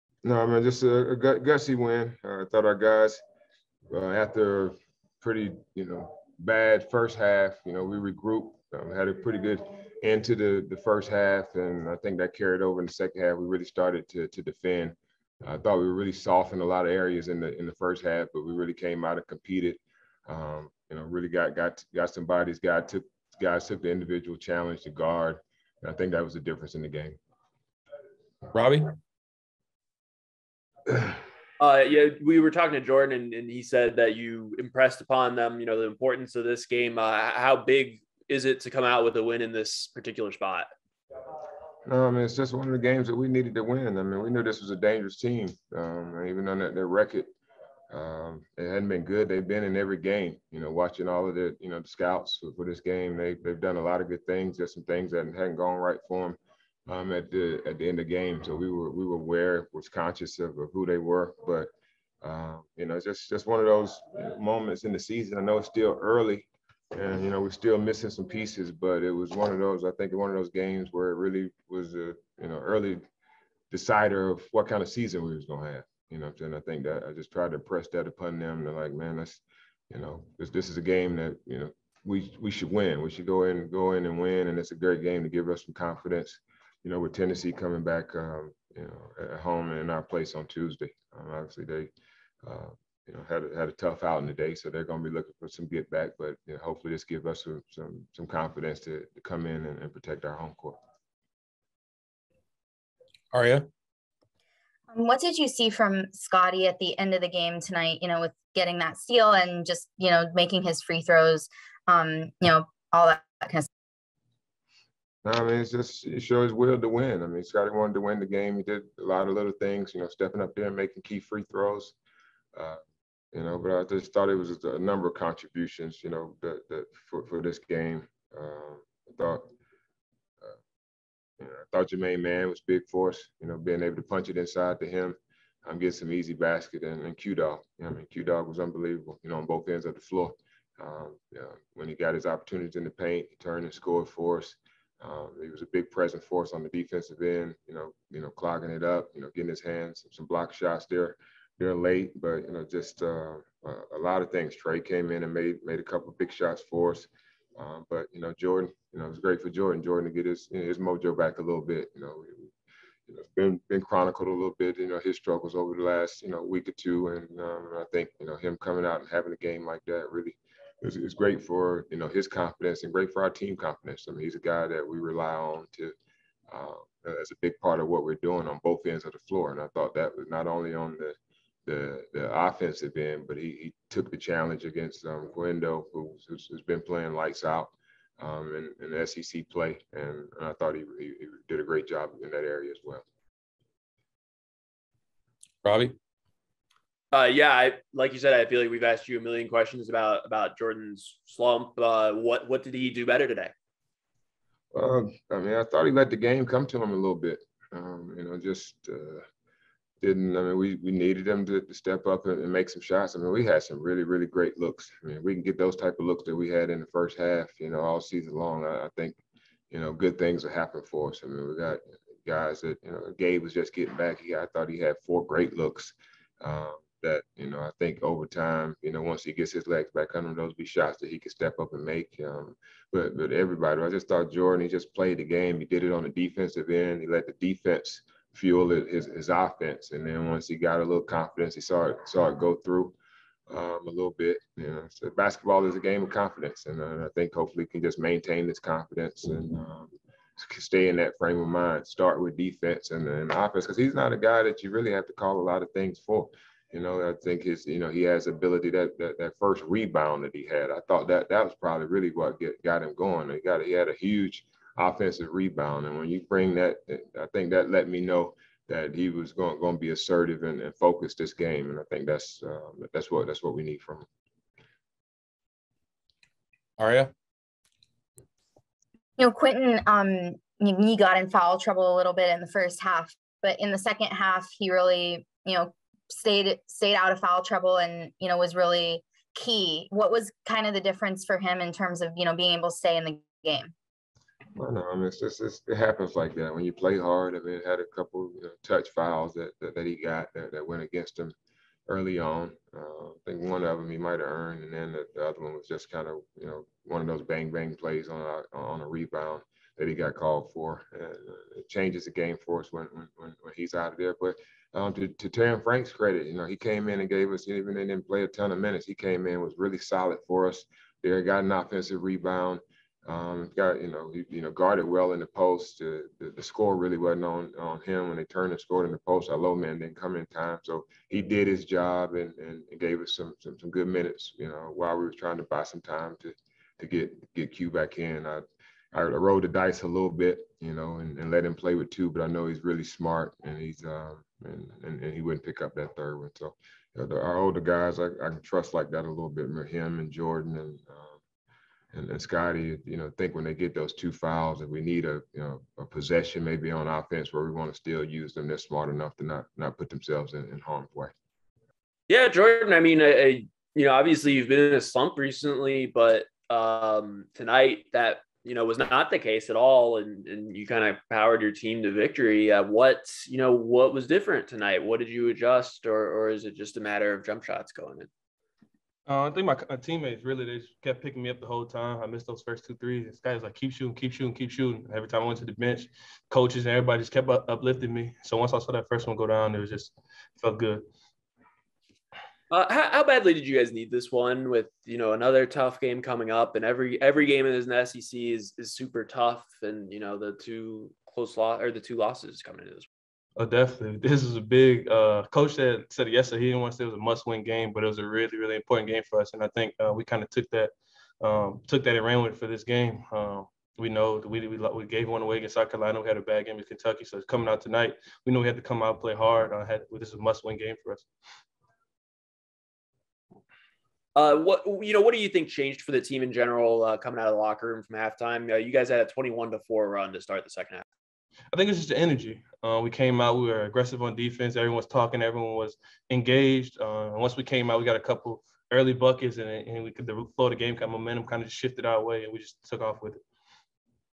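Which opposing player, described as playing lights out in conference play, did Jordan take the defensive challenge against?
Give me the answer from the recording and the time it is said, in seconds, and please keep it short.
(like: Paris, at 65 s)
Guendo, at 185 s.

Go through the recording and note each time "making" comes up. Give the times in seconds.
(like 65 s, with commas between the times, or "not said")
110 s, 120 s.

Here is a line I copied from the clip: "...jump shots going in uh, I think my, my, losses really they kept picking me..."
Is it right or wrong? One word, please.
wrong.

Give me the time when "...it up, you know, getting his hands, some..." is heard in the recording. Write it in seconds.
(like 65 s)
148 s.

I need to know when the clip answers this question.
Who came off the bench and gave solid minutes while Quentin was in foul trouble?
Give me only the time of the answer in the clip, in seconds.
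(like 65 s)
315 s.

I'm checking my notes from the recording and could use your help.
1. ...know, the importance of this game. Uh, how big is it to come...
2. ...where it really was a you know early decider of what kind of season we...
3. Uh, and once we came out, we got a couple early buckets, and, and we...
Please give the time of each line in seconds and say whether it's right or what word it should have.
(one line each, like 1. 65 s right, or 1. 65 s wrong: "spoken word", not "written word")
1. 35 s right
2. 70 s right
3. 436 s right.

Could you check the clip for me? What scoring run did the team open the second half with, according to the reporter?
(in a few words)
21 to 4.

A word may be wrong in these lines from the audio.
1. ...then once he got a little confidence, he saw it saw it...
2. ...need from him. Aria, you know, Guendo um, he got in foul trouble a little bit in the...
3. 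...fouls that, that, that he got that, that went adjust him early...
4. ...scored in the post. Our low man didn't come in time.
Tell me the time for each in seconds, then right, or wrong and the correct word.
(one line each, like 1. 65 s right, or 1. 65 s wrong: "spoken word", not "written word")
1. 240 s right
2. 273 s wrong: "Quentin", not "Guendo"
3. 298 s wrong: "against", not "adjust"
4. 328 s right.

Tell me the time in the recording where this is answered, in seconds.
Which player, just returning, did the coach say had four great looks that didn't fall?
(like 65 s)
223 s.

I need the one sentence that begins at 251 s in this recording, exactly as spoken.
Start with defense and, then offense because he's not a guy that you really have to call a lot of things for.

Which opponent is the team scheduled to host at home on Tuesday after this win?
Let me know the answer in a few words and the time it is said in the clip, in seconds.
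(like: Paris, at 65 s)
Tennessee, at 87 s.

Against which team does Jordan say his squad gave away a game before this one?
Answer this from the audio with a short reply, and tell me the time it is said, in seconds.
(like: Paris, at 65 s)
South Carolina, at 415 s.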